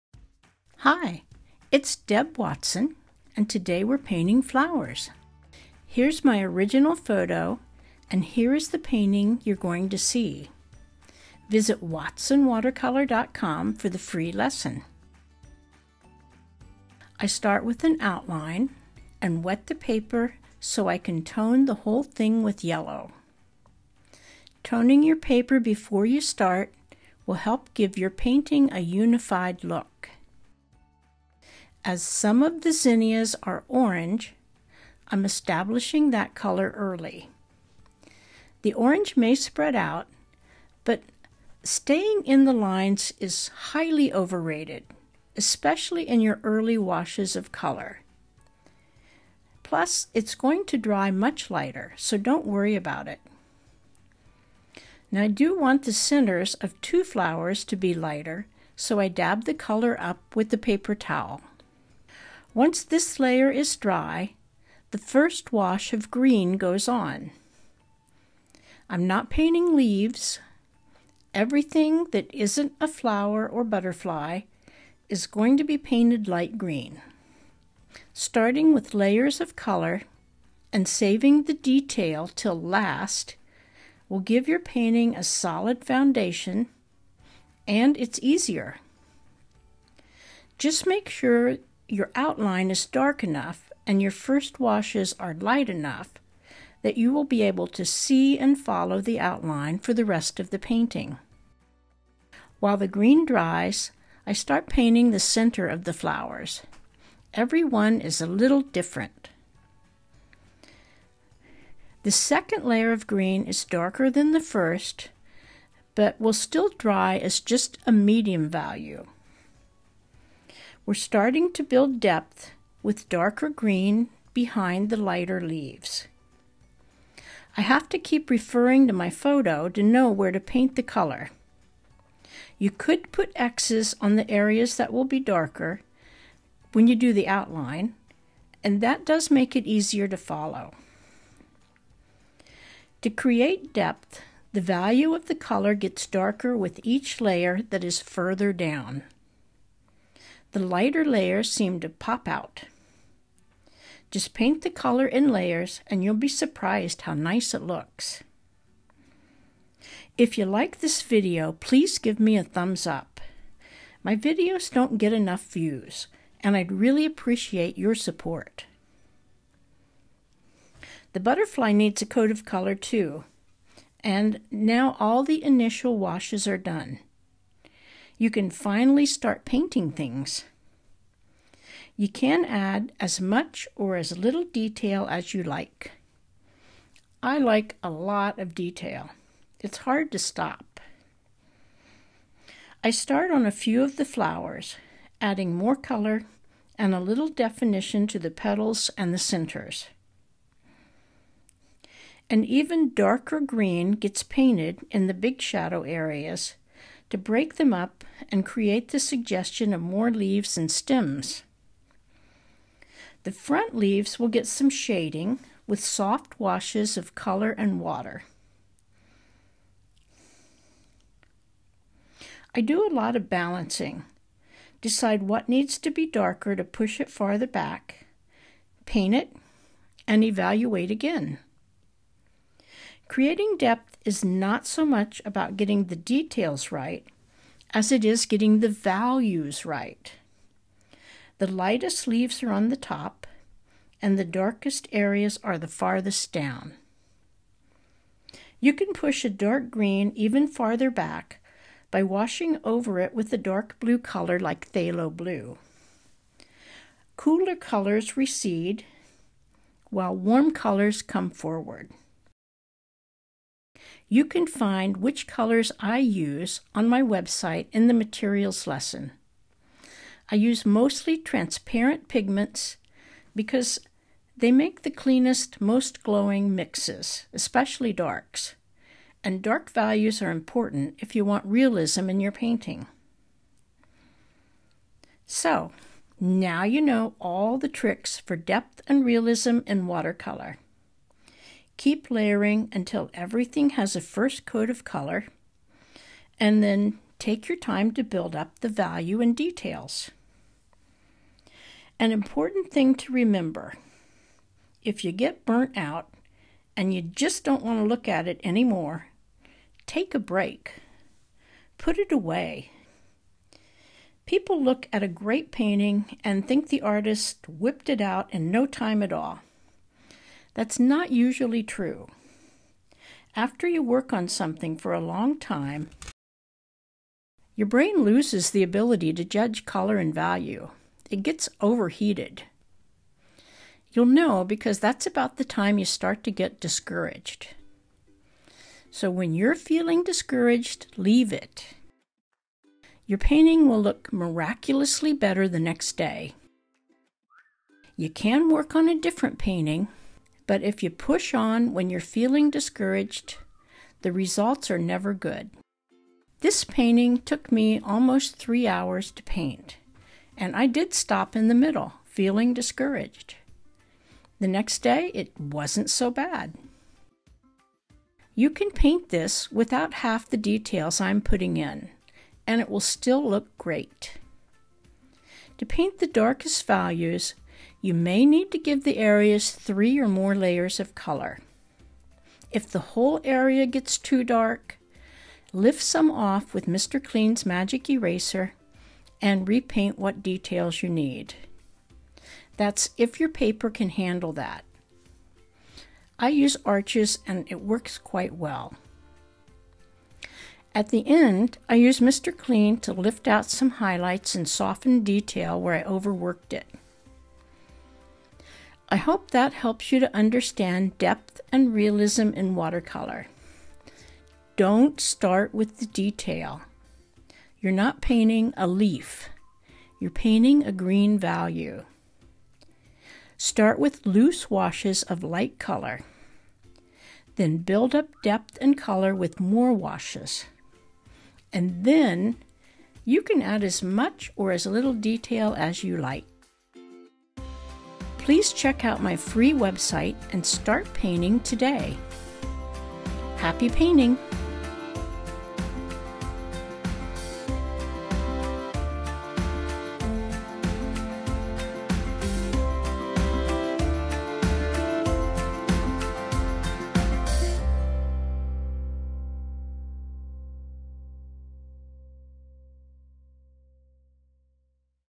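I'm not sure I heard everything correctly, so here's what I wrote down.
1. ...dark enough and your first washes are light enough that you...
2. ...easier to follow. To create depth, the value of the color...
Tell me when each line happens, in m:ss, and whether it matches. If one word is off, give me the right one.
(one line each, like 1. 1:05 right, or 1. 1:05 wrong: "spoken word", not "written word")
1. 1:32 right
2. 2:19 right.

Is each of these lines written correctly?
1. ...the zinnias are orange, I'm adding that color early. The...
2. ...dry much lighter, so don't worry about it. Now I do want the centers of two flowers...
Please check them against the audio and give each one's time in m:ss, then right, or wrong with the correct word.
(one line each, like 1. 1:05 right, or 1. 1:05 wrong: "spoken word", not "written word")
1. 0:32 wrong: "establishing", not "adding"
2. 0:50 right.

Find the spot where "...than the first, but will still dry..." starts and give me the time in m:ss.
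1:54.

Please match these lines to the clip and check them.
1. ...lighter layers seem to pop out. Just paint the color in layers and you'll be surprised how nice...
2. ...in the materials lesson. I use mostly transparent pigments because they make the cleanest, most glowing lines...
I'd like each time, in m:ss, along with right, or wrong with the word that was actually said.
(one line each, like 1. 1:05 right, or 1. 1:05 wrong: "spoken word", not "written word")
1. 2:30 right
2. 4:27 wrong: "mixes", not "lines".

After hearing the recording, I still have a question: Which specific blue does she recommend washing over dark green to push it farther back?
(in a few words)
phthalo blue.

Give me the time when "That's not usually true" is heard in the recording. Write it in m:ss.
5:20.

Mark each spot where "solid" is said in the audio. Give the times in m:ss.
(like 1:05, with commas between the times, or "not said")
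1:25.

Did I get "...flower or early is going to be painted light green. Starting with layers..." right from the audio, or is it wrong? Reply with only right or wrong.
wrong.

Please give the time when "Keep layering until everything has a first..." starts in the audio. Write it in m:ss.
4:51.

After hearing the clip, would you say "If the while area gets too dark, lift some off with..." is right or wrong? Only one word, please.
wrong.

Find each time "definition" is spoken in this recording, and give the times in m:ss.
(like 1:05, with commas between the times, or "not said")
3:17.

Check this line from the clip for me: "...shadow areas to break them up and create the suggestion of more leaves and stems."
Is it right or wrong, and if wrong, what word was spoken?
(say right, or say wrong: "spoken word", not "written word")
right.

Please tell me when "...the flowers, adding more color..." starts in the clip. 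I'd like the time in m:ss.
3:13.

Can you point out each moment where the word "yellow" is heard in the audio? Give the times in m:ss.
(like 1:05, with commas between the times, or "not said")
0:22.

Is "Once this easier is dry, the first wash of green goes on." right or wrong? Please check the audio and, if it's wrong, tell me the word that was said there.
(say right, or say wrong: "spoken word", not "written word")
wrong: "layer", not "easier".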